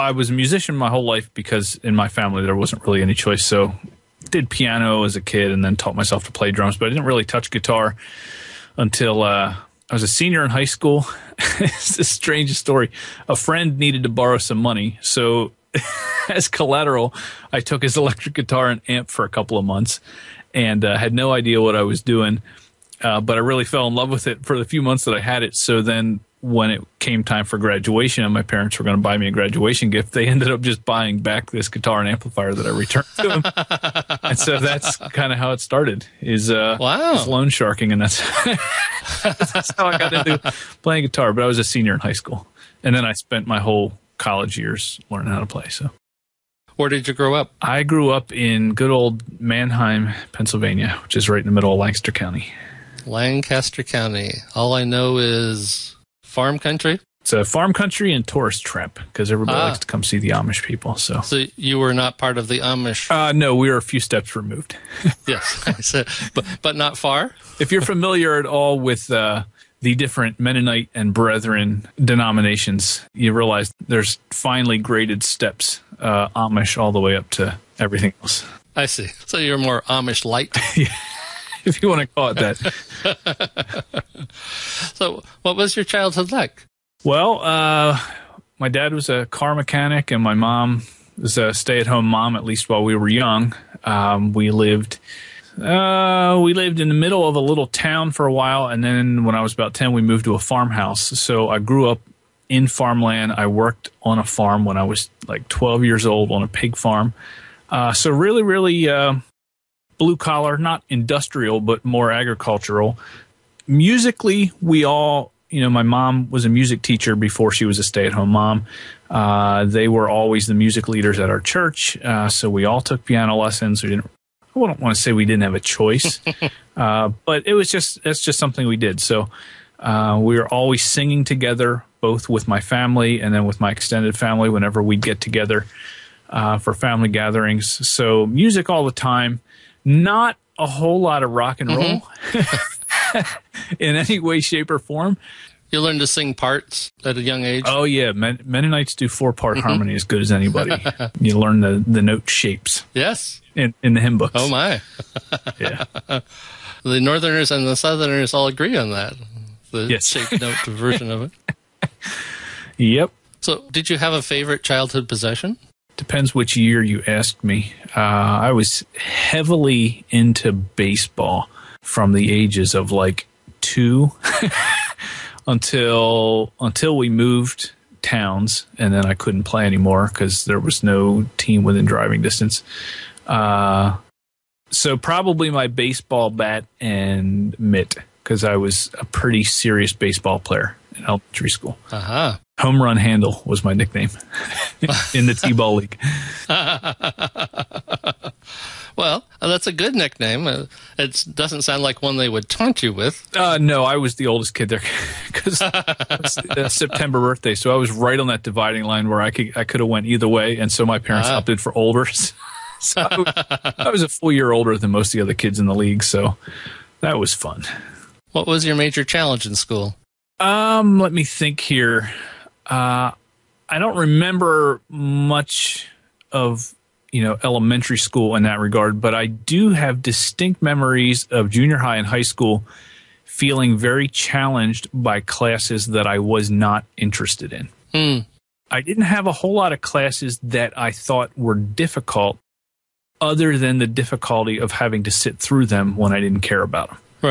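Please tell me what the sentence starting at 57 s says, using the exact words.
It's a farm country and tourist trip because everybody ah.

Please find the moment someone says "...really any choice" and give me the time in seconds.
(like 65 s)
2 s.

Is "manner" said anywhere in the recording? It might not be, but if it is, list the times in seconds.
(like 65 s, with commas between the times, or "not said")
not said.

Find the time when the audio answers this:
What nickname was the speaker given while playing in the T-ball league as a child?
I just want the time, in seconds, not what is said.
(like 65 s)
192 s.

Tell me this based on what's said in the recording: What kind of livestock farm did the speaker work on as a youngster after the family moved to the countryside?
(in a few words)
Pig farm.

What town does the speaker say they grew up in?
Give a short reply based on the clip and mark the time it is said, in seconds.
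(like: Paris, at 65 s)
Manheim, at 49 s.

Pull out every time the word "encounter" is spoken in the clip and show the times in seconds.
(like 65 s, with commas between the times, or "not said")
not said.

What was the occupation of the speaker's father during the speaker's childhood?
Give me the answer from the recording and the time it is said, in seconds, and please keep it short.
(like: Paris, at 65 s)
Car mechanic, at 89 s.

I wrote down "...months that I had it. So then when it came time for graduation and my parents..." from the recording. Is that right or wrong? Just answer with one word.
right.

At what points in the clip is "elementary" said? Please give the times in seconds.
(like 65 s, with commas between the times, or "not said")
191 s, 227 s.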